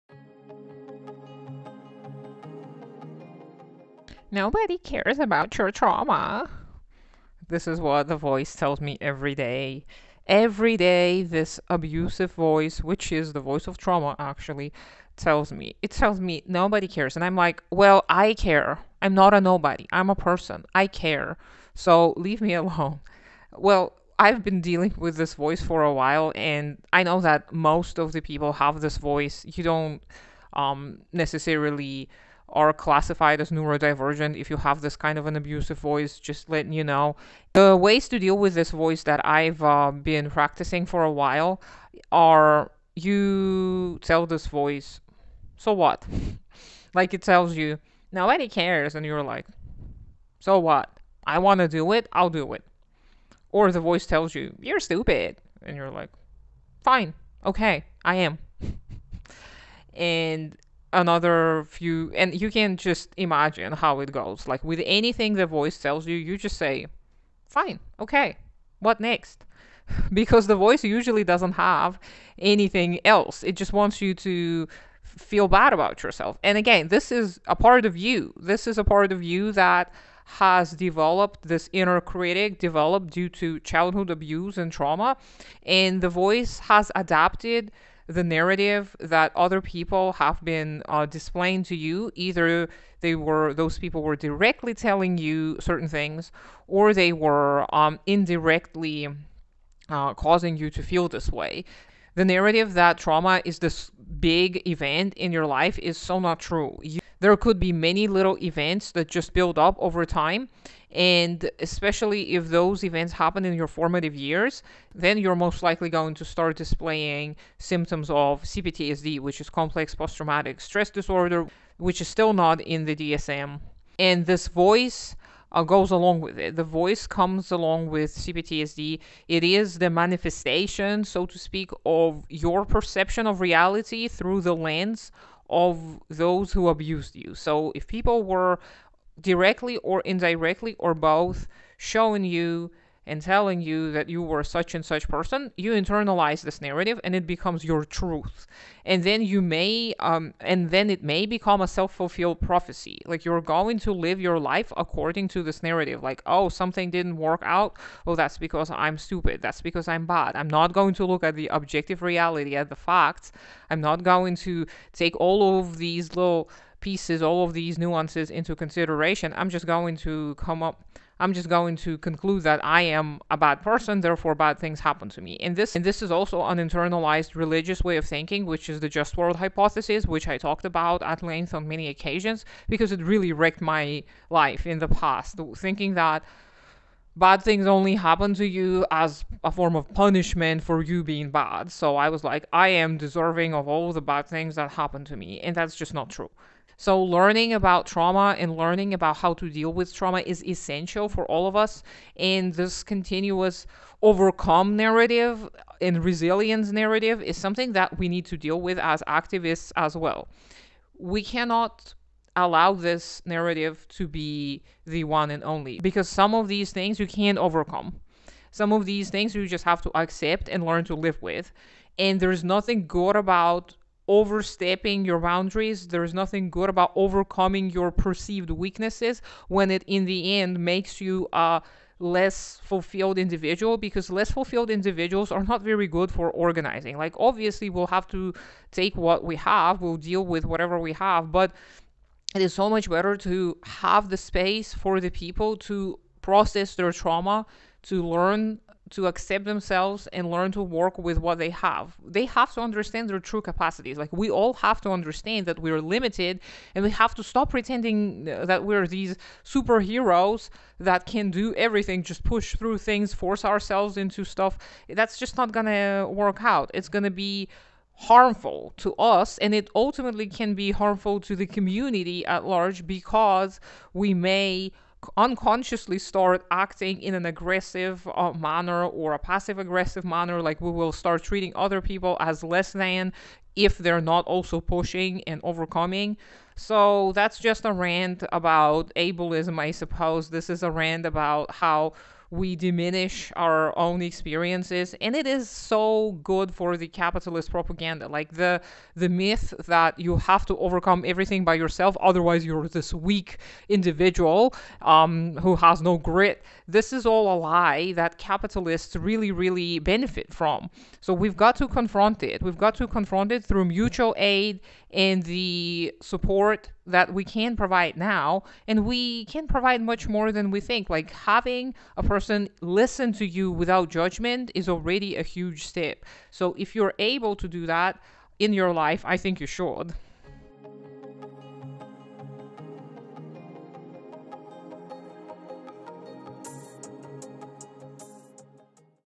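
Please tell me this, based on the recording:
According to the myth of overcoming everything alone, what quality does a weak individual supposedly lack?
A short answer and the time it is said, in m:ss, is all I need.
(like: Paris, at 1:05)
grit, at 5:05.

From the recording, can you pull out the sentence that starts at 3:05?
Thinking that bad things only happen to you as a form of punishment for you being bad.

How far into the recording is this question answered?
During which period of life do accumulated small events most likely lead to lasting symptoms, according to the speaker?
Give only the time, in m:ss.
1:53.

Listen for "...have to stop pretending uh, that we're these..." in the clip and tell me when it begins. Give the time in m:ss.
4:16.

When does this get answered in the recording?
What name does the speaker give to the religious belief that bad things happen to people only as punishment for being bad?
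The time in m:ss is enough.
2:58.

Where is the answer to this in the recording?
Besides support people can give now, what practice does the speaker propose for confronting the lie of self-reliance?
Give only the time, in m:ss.
5:13.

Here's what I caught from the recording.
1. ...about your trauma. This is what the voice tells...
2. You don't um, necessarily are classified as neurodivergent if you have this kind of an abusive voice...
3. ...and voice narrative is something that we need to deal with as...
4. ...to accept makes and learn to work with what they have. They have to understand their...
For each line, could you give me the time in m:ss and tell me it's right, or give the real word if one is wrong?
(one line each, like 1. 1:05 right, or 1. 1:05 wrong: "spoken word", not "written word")
1. 0:05 right
2. 0:29 right
3. 3:25 wrong: "resilience", not "voice"
4. 4:08 wrong: "themselves", not "makes".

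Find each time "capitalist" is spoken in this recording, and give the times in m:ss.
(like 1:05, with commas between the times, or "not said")
4:56, 5:08.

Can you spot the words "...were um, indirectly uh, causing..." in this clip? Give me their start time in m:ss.
1:37.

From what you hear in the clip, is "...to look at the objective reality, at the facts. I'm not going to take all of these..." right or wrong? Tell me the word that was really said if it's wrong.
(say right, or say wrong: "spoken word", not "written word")
right.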